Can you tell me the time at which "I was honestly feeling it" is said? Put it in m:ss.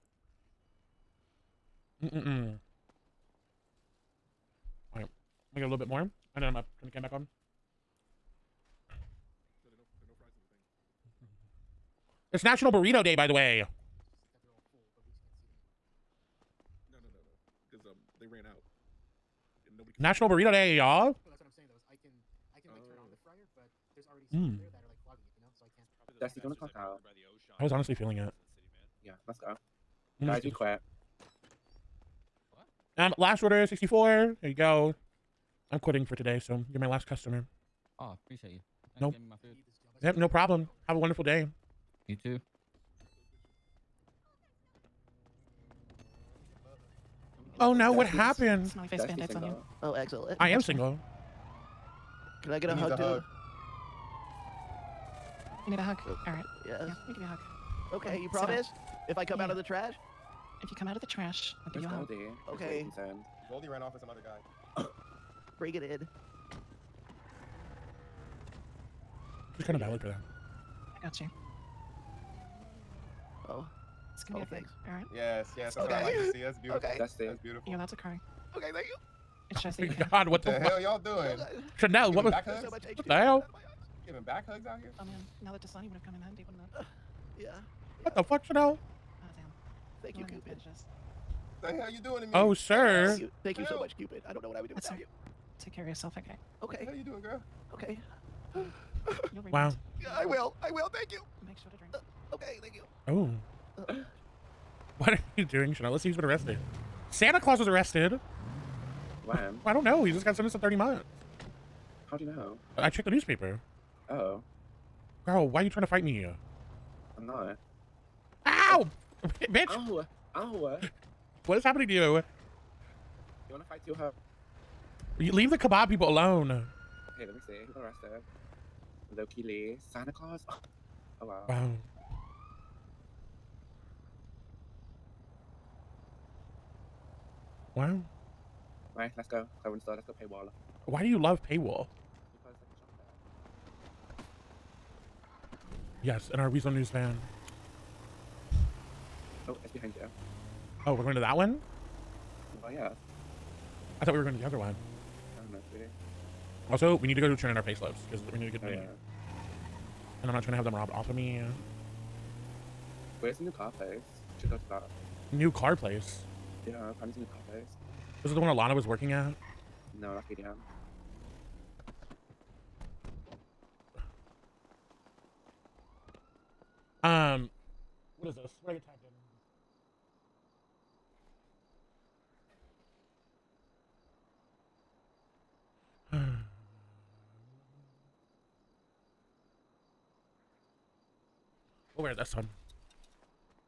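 0:27.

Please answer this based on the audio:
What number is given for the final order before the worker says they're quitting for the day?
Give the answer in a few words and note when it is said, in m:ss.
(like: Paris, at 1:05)
64, at 0:33.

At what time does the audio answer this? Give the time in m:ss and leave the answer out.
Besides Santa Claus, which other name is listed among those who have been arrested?
2:09.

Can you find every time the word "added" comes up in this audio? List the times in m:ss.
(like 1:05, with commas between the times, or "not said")
not said.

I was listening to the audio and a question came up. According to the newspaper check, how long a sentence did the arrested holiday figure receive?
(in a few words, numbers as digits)
30 months.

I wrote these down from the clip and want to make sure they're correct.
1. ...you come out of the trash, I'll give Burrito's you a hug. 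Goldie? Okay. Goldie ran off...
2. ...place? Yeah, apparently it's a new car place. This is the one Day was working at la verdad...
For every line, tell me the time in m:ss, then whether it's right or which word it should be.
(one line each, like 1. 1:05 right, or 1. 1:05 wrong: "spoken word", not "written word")
1. 1:00 wrong: "Where", not "Burrito"
2. 2:45 wrong: "Alana", not "Day".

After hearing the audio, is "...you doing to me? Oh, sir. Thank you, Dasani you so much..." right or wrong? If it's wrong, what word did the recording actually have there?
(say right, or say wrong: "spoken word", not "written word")
wrong: "Thank", not "Dasani".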